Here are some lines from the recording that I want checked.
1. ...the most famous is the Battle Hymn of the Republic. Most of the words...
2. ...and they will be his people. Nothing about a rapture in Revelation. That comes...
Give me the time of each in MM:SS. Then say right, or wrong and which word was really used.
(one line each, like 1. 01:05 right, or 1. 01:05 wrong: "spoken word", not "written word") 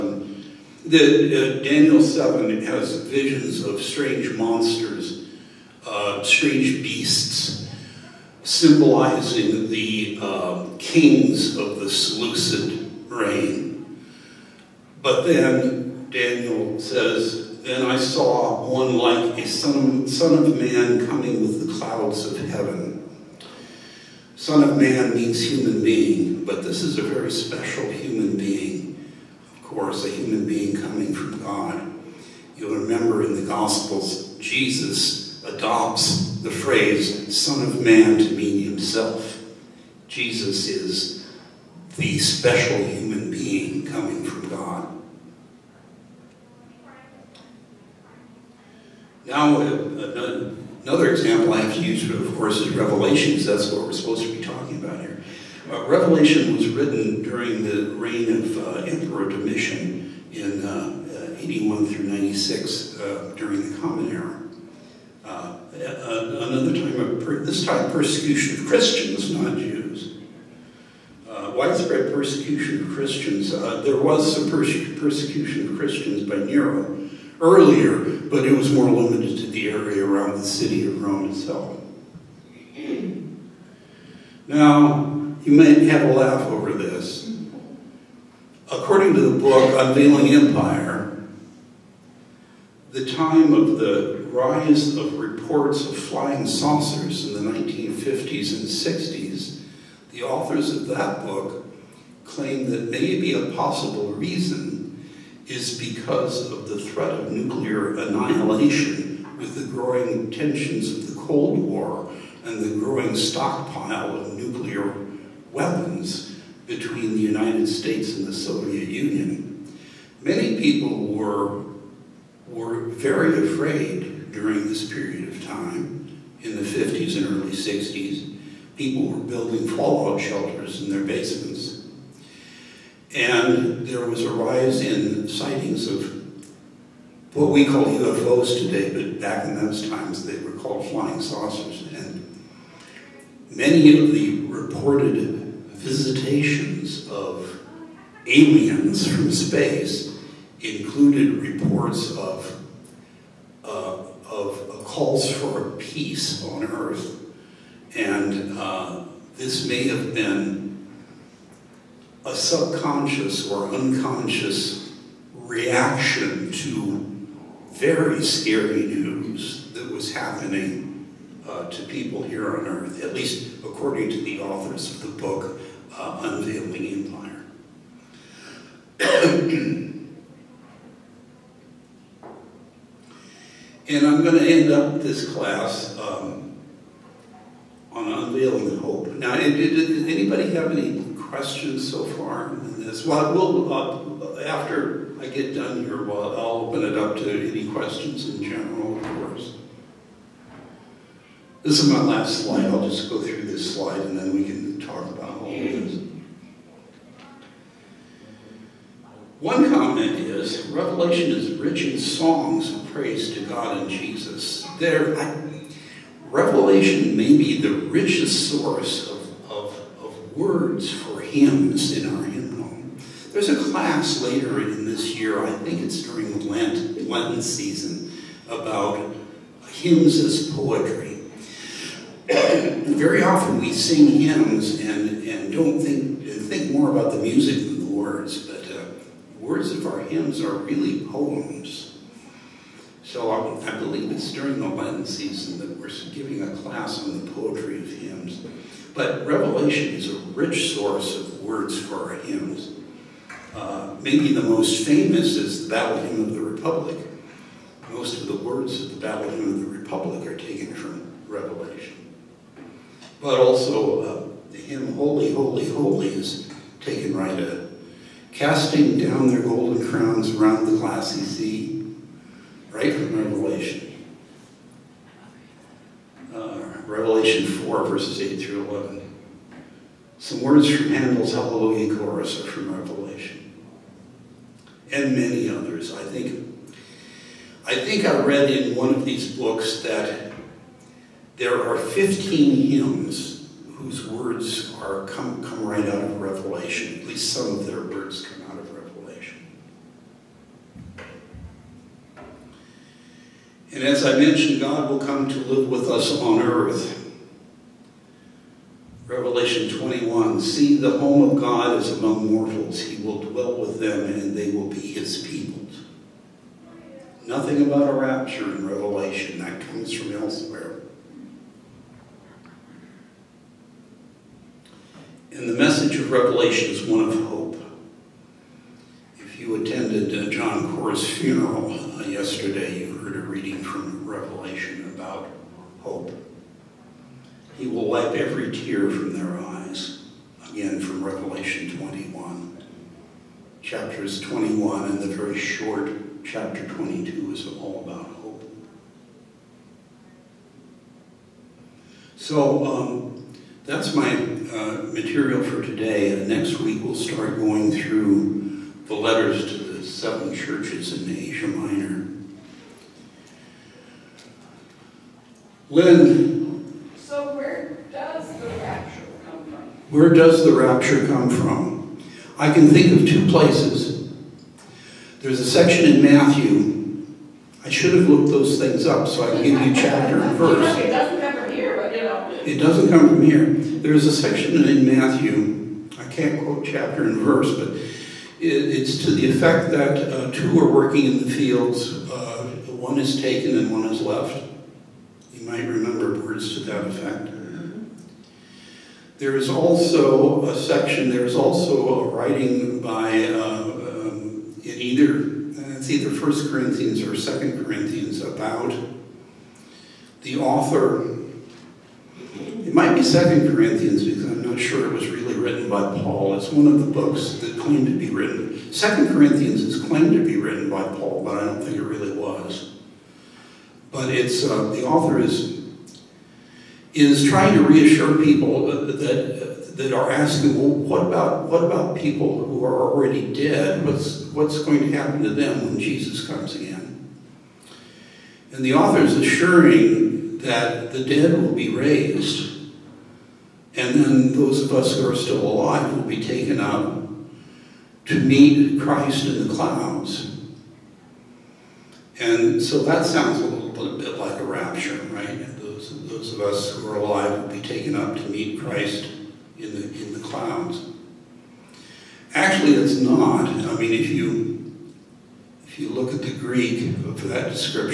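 1. 04:14 right
2. 05:14 right.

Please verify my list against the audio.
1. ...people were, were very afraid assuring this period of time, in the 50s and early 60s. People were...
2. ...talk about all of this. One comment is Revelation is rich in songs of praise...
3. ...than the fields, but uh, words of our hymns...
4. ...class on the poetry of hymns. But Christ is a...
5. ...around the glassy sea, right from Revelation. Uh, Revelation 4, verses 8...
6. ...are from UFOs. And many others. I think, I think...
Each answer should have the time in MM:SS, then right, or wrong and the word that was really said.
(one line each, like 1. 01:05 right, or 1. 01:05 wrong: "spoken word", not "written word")
1. 02:00 wrong: "during", not "assuring"
2. 03:24 right
3. 03:57 wrong: "words", not "fields"
4. 04:06 wrong: "Revelation", not "Christ"
5. 04:30 right
6. 04:42 wrong: "Revelation", not "UFOs".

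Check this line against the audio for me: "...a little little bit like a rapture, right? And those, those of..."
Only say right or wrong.
right.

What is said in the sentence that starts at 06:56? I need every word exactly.
It's one of the books that claimed to be written.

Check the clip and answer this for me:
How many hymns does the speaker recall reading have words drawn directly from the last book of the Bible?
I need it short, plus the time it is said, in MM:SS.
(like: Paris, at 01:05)
15, at 04:51.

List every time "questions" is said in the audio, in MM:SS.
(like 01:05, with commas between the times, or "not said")
03:11, 03:17.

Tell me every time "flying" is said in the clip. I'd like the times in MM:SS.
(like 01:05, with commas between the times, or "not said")
01:35, 02:20.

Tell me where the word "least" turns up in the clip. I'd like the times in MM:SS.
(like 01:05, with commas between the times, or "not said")
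02:53, 04:57.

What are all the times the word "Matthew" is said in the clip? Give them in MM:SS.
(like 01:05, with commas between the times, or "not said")
06:16, 06:24.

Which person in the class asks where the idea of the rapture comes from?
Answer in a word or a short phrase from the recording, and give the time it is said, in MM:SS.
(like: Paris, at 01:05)
Lynn, at 06:05.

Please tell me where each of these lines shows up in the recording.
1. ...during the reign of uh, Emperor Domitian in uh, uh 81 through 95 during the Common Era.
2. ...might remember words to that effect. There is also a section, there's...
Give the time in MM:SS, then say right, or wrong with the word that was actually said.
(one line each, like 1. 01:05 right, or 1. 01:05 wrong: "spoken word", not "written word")
1. 00:57 wrong: "96", not "95"
2. 06:35 right.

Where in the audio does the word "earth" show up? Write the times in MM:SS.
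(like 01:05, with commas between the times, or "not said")
02:36, 02:52, 05:06.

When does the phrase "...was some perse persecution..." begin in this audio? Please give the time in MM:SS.
01:13.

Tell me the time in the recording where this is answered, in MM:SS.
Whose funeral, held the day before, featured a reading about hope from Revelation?
05:30.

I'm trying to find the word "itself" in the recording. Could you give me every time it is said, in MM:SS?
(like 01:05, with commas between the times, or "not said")
01:21.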